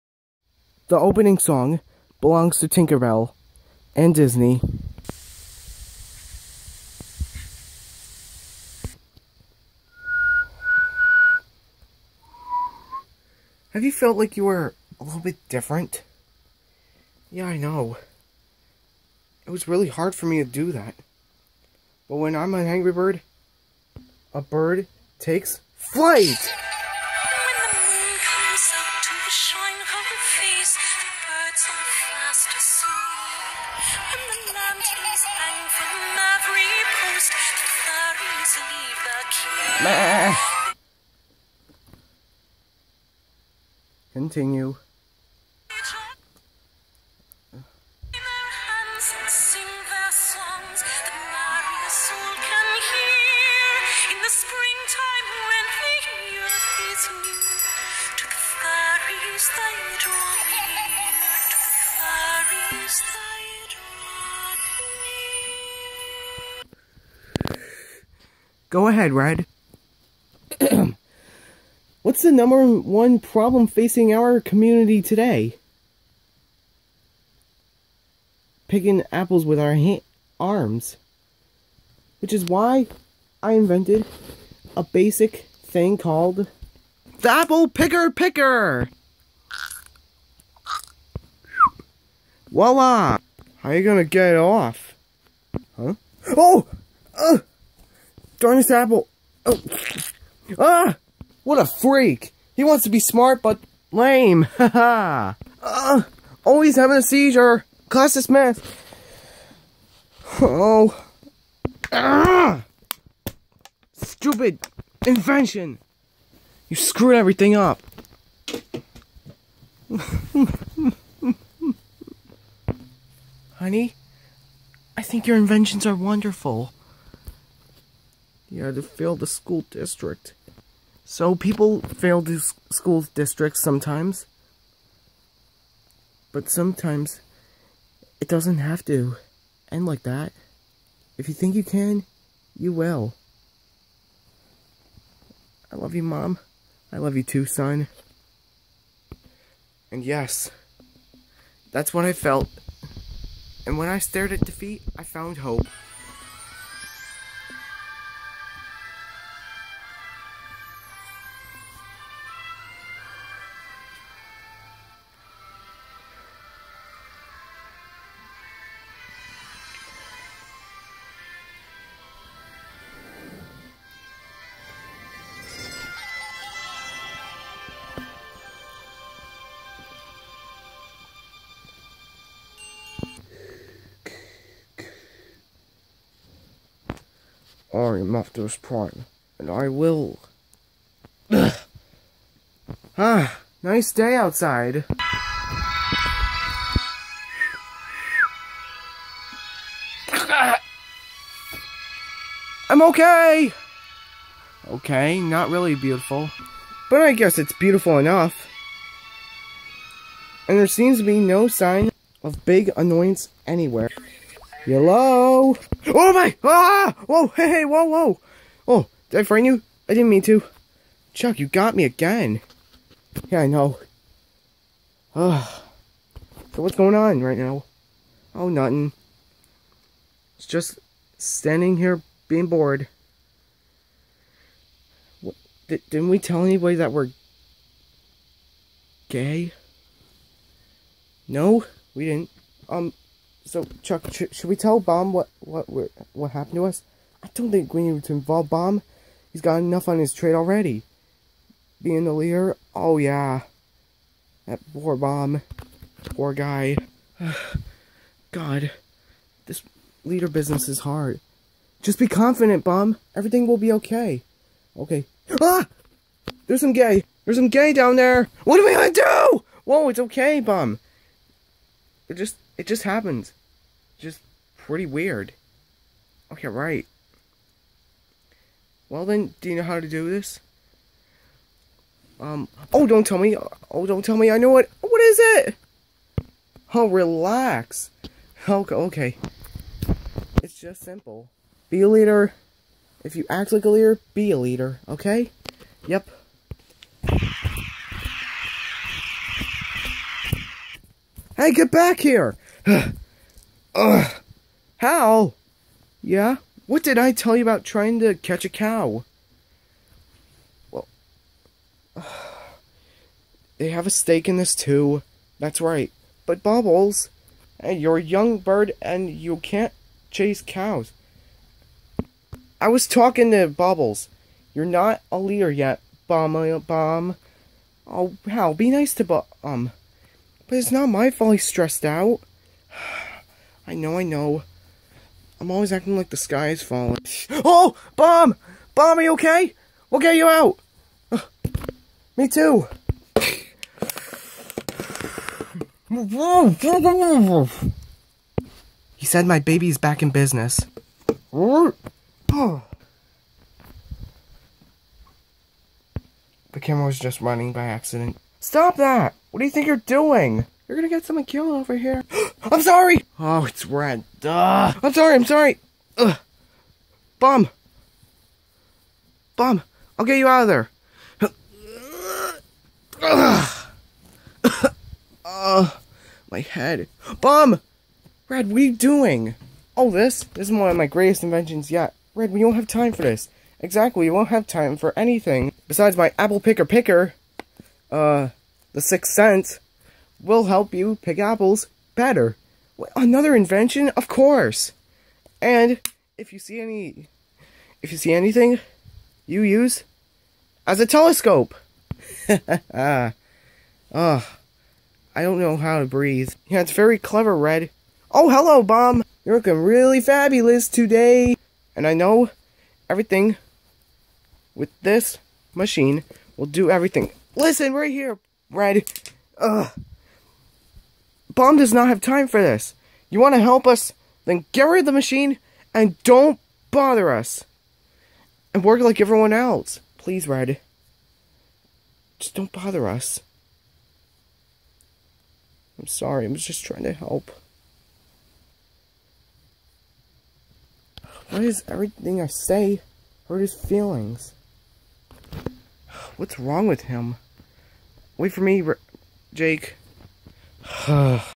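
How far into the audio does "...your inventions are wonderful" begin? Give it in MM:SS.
02:05.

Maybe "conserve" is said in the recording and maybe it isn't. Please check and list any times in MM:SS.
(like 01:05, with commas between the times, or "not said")
not said.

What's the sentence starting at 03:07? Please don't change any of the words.
I am Optimus Prime, and I will.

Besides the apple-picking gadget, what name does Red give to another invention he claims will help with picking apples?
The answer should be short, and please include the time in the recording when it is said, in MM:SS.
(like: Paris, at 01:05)
the sixth sense, at 06:28.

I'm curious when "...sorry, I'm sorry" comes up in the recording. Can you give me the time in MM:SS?
06:04.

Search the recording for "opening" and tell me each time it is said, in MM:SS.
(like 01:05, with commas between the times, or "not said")
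00:00.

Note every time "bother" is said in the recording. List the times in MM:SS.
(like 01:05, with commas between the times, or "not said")
07:06, 07:12.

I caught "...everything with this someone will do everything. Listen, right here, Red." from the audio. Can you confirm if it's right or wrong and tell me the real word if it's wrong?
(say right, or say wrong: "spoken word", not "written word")
wrong: "machine", not "someone".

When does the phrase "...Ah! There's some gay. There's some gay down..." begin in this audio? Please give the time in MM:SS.
04:25.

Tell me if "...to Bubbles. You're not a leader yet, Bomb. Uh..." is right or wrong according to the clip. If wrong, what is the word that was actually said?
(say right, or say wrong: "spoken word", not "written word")
right.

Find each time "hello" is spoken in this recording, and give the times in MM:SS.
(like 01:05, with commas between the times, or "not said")
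03:34, 06:48.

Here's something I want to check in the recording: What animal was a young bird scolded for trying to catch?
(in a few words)
cow.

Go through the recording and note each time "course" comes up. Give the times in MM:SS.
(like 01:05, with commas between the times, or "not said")
06:34.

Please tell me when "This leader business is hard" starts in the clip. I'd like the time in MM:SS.
04:19.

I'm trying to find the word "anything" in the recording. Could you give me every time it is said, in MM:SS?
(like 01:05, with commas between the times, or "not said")
06:24, 06:38.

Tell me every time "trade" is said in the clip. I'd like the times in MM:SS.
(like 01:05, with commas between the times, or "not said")
04:10.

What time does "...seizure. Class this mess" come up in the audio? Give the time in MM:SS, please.
01:47.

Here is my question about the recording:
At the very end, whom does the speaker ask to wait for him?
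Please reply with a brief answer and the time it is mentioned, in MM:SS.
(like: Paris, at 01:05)
Jake, at 07:29.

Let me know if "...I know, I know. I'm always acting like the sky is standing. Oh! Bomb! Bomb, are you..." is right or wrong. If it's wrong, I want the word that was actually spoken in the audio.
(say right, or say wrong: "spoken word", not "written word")
wrong: "falling", not "standing".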